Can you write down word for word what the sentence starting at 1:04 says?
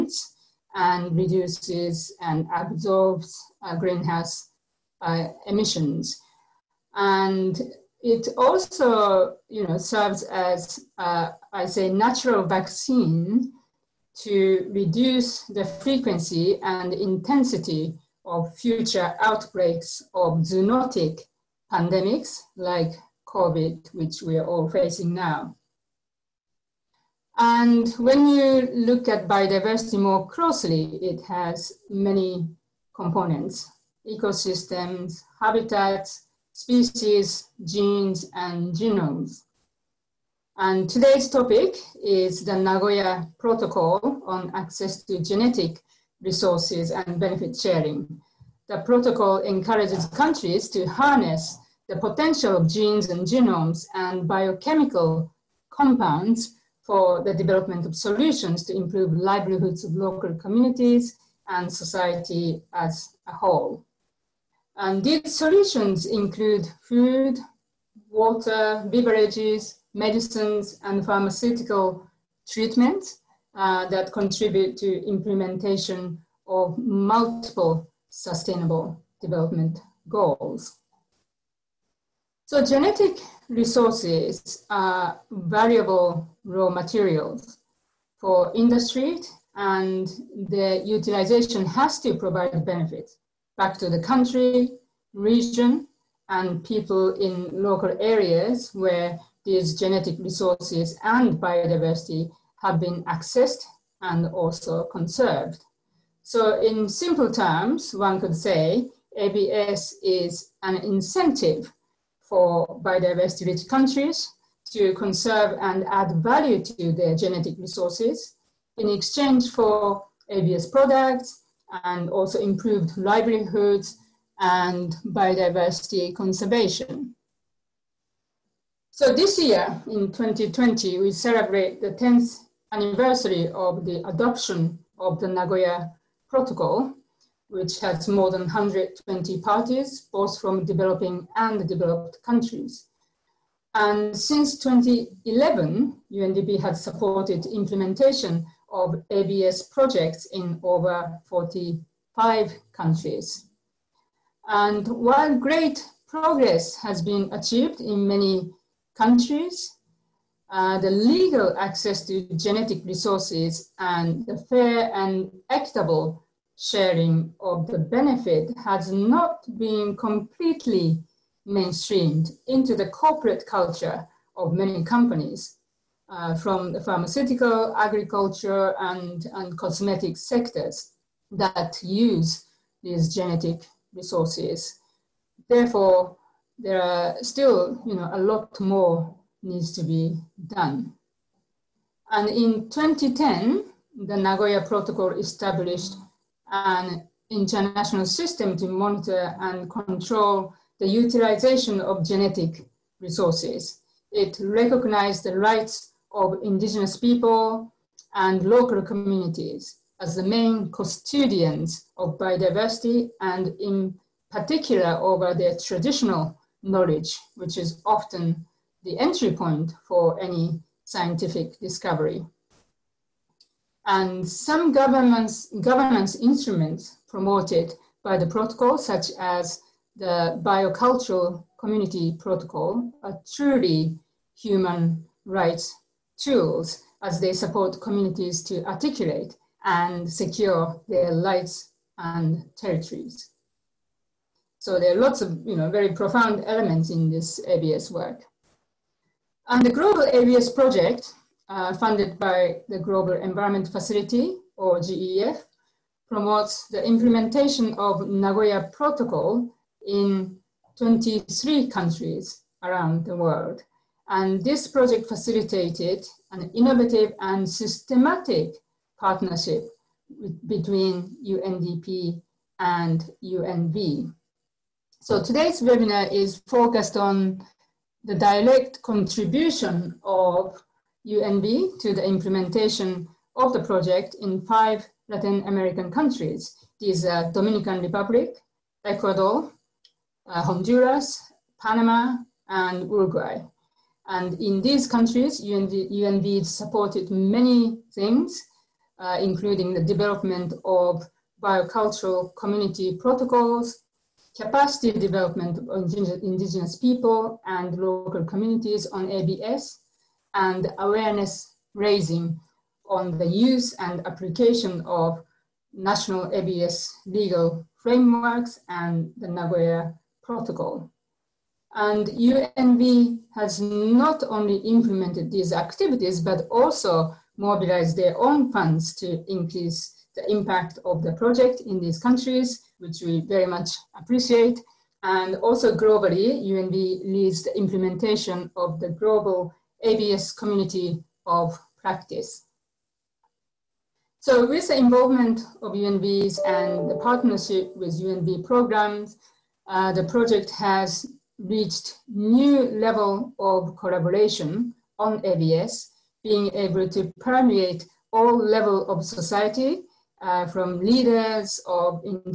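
And these solutions include food, water, beverages, medicines, and pharmaceutical treatments uh, that contribute to implementation of multiple sustainable development goals.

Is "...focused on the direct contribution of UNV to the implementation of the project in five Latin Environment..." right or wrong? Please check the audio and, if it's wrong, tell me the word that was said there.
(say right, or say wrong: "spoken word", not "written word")
wrong: "American", not "Environment".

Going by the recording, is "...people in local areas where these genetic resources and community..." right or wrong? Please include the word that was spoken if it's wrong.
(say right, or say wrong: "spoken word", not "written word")
wrong: "biodiversity", not "community".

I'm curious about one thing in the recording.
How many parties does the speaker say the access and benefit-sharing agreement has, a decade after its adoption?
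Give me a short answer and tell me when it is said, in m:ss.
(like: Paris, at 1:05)
more than 120, at 2:18.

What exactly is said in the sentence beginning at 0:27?
And when you look at biodiversity more closely, it has many components, ecosystems, habitats, species, genes, and genomes.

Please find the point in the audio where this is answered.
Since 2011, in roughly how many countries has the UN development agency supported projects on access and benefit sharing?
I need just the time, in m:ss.
2:30.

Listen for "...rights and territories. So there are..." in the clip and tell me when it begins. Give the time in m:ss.
4:01.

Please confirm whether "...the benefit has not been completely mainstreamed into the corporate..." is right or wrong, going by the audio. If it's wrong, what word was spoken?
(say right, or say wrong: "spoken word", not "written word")
right.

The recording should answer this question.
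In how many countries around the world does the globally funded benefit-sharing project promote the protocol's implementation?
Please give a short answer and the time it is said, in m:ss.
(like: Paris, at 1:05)
23, at 4:20.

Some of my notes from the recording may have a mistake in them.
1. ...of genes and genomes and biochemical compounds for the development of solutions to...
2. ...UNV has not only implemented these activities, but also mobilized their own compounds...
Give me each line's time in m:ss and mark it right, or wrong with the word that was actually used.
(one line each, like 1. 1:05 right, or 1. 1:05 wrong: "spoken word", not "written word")
1. 0:52 right
2. 5:22 wrong: "funds", not "compounds".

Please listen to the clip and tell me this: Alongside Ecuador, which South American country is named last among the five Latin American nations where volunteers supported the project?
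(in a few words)
Uruguay.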